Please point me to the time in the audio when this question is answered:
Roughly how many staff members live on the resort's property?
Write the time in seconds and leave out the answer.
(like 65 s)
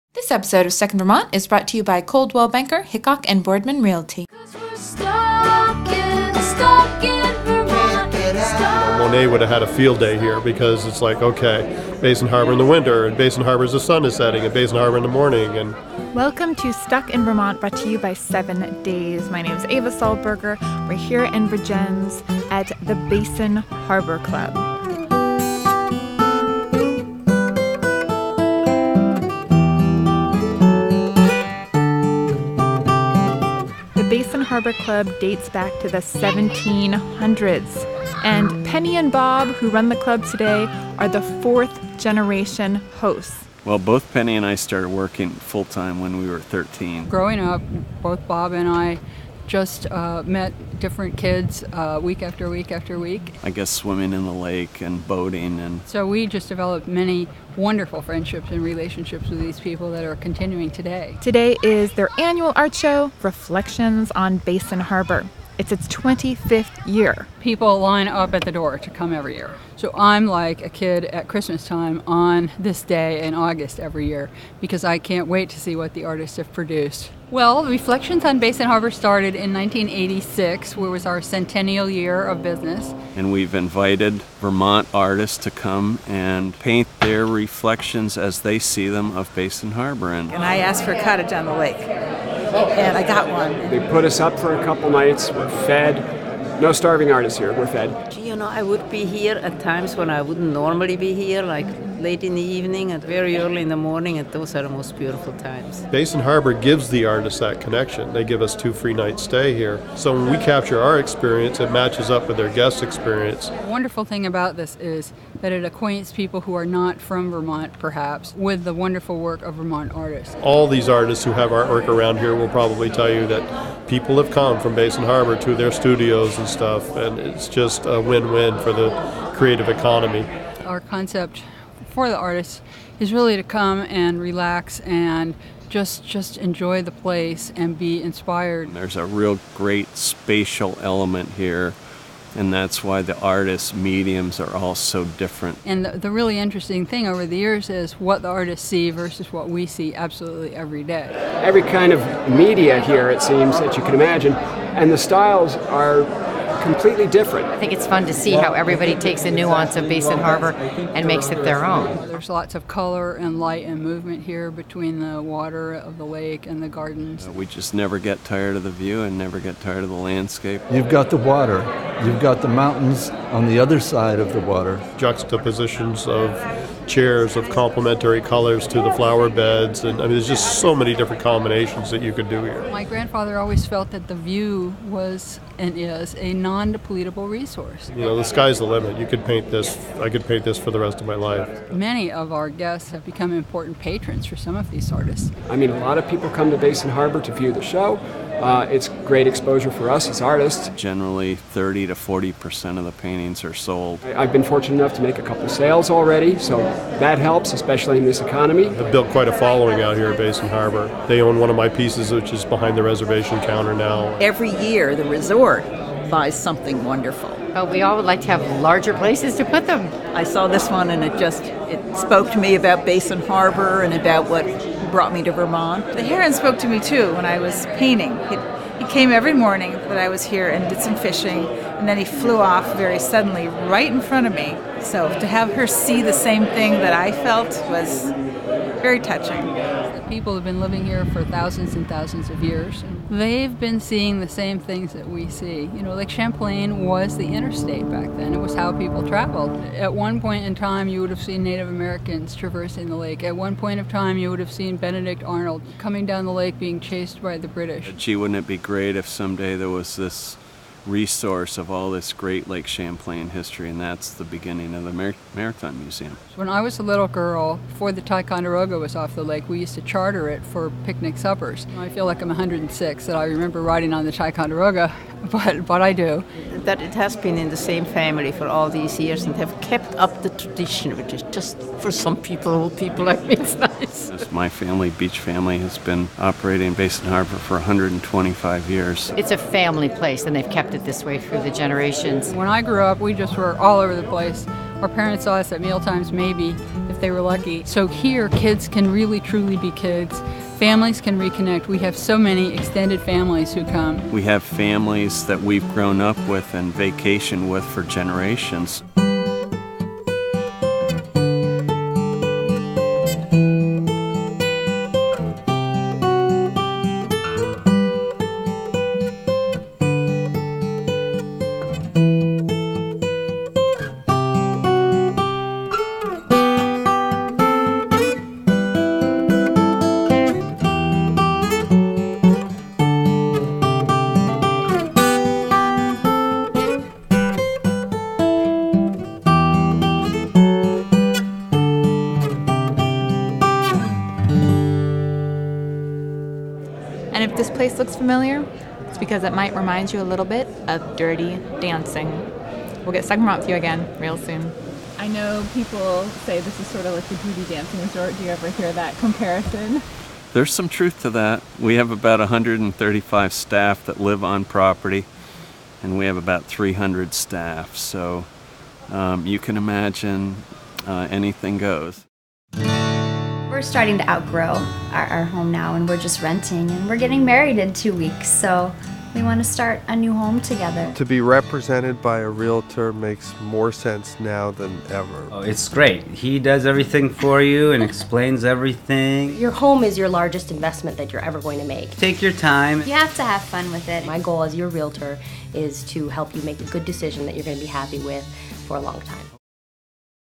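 362 s.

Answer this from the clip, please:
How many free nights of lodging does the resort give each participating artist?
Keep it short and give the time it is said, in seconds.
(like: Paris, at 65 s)
2, at 108 s.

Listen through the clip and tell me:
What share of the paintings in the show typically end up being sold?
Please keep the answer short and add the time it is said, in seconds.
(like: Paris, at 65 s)
30 to 40 percent, at 201 s.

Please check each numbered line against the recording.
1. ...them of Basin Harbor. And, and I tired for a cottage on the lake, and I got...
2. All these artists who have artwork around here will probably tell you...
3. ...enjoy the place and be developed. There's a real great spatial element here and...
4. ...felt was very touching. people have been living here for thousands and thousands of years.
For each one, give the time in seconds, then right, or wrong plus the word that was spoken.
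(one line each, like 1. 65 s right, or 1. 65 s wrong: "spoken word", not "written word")
1. 88 s wrong: "asked", not "tired"
2. 120 s right
3. 136 s wrong: "inspired", not "developed"
4. 237 s right.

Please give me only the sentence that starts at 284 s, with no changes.
my family, Beach Family, has been operating in Basin Harbor for 125 years.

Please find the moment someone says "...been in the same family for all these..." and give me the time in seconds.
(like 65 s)
277 s.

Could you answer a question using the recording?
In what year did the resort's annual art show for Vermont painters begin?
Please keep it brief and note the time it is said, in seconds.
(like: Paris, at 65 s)
1986, at 79 s.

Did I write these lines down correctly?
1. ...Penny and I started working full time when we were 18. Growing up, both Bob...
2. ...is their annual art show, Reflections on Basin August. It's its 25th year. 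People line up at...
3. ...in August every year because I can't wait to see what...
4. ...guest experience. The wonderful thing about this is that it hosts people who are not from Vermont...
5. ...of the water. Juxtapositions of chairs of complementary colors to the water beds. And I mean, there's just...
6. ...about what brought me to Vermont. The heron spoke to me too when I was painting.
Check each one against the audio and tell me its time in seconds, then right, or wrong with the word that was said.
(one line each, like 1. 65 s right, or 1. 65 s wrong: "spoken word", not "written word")
1. 44 s wrong: "13", not "18"
2. 61 s wrong: "Harbor", not "August"
3. 73 s right
4. 112 s wrong: "acquaints", not "hosts"
5. 174 s wrong: "flower", not "water"
6. 223 s right.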